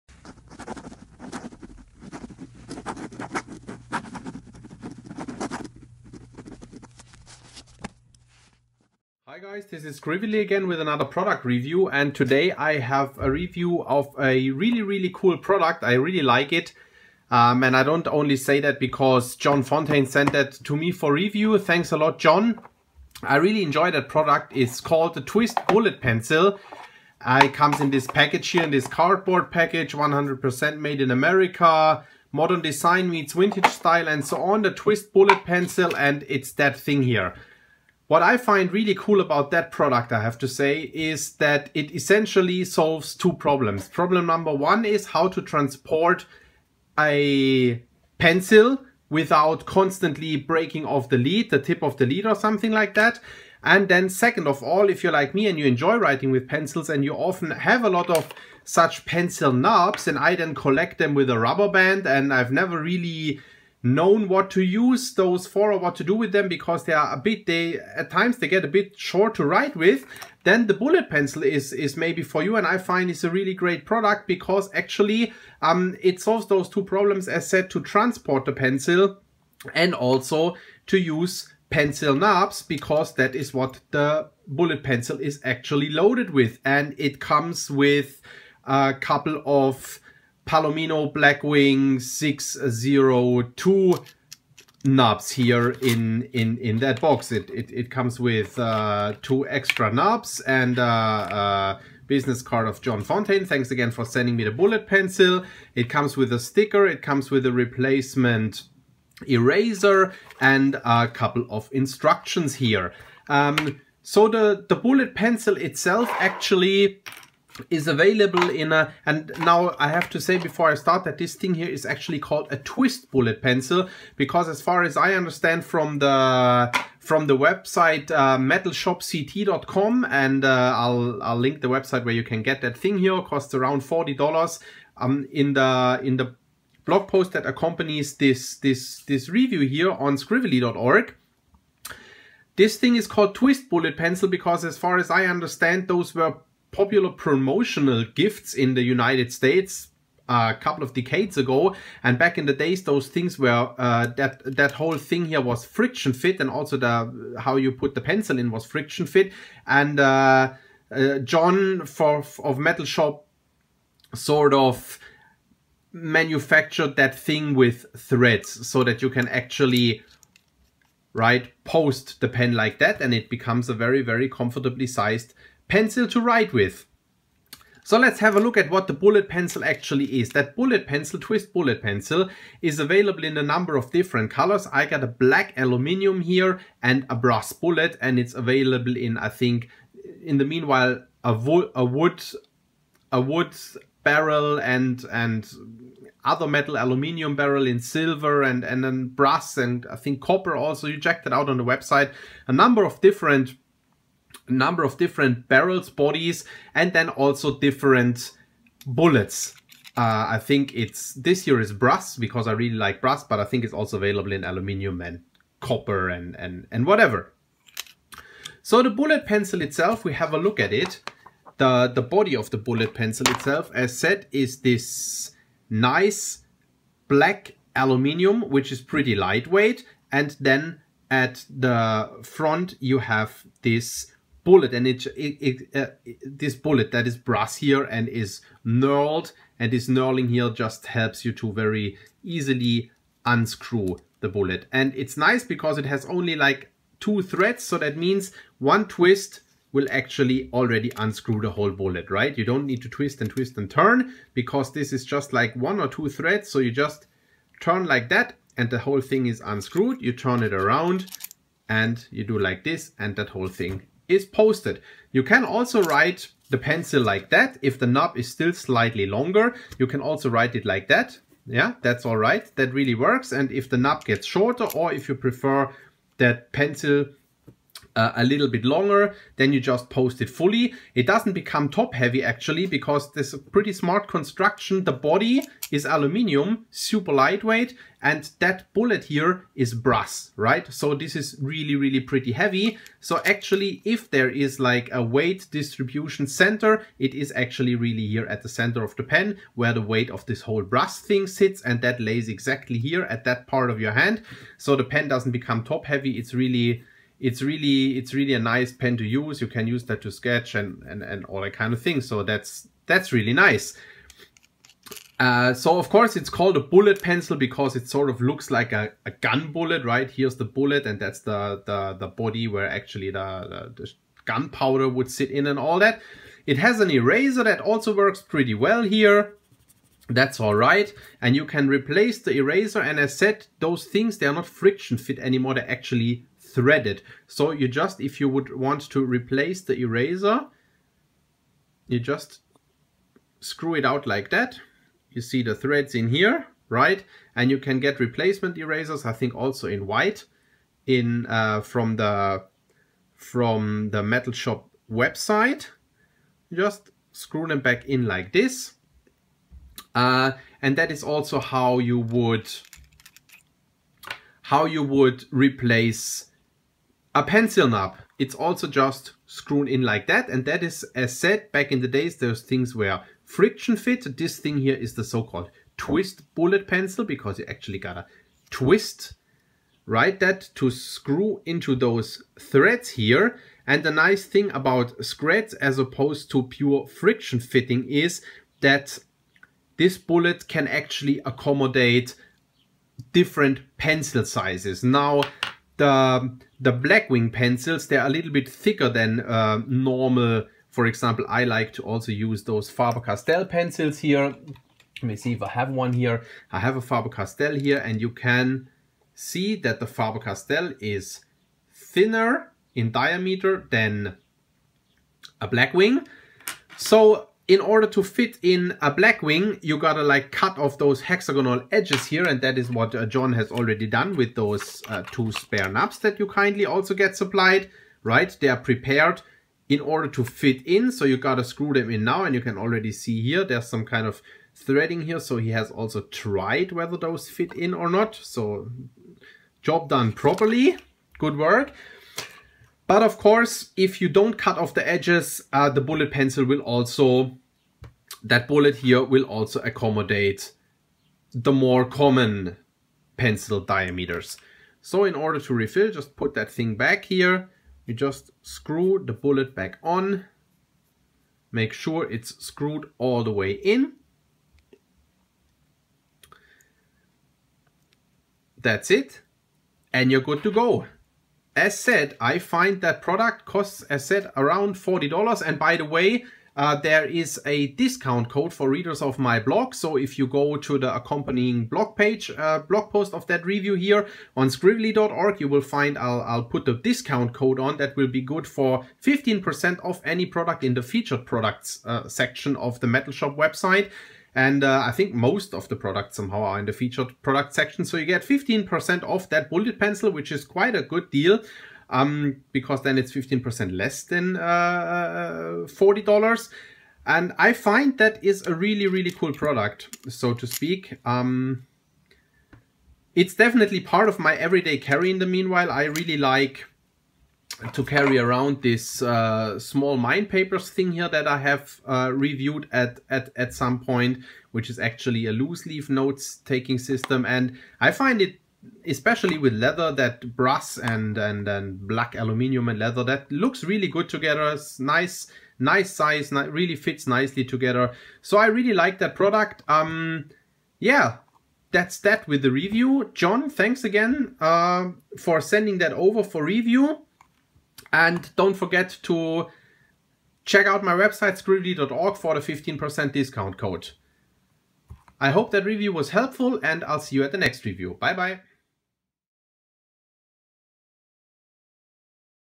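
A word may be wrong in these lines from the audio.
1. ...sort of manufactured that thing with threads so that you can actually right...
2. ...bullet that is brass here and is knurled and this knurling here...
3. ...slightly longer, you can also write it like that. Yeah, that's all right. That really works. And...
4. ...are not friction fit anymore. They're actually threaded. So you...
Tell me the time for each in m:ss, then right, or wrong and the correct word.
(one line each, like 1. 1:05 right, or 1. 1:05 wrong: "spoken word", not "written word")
1. 2:44 right
2. 3:56 right
3. 4:28 right
4. 5:34 right.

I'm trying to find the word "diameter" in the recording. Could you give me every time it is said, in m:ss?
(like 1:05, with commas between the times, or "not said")
6:52, 7:33.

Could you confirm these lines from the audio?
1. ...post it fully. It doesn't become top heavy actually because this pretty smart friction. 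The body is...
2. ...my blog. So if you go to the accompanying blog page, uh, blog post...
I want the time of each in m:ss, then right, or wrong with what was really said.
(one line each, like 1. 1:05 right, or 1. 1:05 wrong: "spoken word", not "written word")
1. 4:39 wrong: "construction", not "friction"
2. 7:59 right.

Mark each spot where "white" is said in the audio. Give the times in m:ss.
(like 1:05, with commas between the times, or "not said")
5:49.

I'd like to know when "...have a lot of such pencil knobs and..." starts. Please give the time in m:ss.
0:57.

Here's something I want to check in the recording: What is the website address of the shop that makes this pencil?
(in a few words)
metalshopct.com.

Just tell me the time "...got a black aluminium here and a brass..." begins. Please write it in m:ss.
3:04.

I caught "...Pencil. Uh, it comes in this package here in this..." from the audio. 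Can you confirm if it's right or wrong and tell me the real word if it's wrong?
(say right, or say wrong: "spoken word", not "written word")
right.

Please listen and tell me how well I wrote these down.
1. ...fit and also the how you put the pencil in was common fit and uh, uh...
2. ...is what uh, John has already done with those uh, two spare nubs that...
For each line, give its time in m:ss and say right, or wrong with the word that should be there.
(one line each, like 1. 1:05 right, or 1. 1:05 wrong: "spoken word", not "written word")
1. 2:36 wrong: "friction", not "common"
2. 7:02 right.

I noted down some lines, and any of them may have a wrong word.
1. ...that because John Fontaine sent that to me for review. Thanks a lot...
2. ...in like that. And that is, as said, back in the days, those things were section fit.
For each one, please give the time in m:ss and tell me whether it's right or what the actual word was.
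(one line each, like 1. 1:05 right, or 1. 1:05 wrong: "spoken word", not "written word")
1. 0:18 right
2. 6:09 wrong: "friction", not "section".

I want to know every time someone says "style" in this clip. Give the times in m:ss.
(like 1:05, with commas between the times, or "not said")
0:33.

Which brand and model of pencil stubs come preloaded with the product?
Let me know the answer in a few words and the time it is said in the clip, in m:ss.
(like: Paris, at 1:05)
Palomino Blackwing 602, at 1:30.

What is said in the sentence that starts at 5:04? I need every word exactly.
So the pen doesn't become top heavy.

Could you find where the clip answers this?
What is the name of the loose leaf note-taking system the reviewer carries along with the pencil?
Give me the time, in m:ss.
8:39.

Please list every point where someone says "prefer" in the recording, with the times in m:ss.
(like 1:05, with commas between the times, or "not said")
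4:35.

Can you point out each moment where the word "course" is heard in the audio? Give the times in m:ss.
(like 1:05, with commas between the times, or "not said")
5:15, 7:23.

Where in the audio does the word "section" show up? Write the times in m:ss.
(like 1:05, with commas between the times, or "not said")
8:12, 8:17.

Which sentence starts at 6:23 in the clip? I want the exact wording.
And the nice thing about scratch as opposed to pure friction fitting is that this bullet can actually accommodate different pencil sizes.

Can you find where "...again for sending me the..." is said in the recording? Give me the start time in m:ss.
1:43.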